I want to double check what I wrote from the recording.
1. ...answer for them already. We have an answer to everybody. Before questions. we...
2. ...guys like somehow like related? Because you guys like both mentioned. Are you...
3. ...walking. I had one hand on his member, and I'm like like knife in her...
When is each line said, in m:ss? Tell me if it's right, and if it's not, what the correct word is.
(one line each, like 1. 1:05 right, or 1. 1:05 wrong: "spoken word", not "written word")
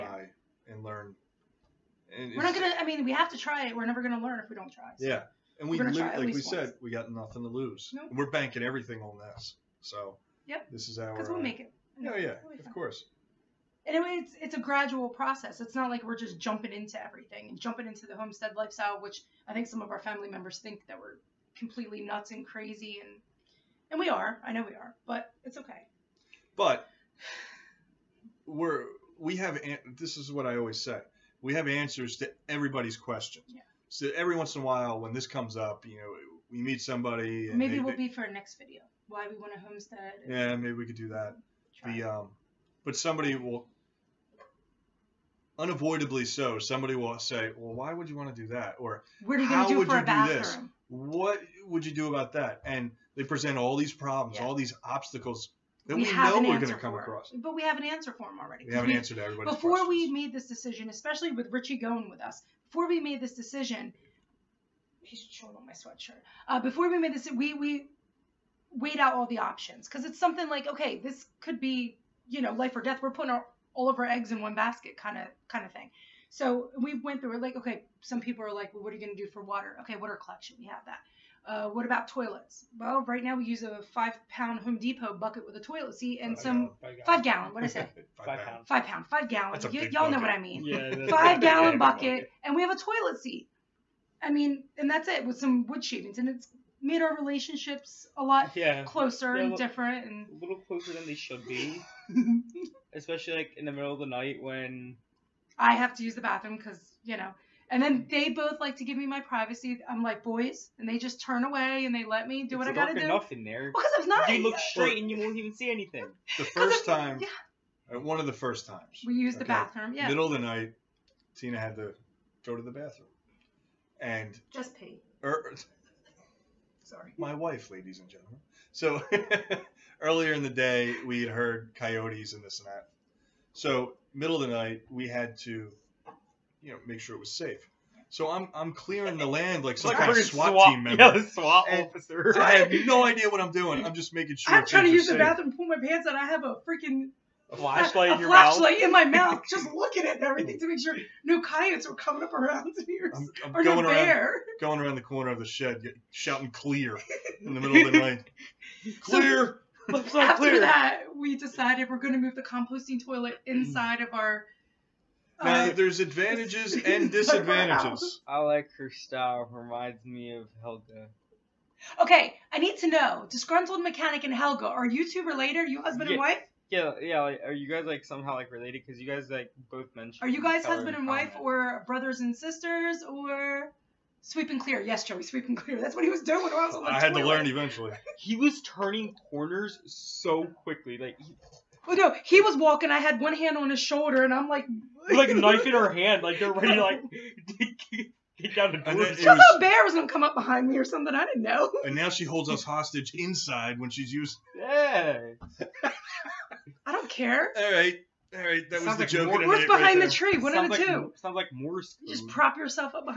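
1. 0:57 right
2. 2:57 right
3. 3:12 wrong: "shoulder", not "member".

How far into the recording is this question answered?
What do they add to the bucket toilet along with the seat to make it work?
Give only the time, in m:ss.
1:35.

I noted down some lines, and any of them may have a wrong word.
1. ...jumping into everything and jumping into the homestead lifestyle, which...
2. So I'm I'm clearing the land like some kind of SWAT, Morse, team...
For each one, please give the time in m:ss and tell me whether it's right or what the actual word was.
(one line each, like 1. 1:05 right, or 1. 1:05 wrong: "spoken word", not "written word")
1. 0:16 right
2. 2:18 wrong: "SWAT", not "Morse".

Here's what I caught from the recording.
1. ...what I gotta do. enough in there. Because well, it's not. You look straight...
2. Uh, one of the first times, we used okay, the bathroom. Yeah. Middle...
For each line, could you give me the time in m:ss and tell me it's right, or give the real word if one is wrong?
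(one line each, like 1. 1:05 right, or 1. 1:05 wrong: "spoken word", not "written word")
1. 1:52 right
2. 1:57 right.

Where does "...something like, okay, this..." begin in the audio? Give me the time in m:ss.
1:10.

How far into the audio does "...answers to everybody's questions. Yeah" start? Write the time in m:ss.
0:31.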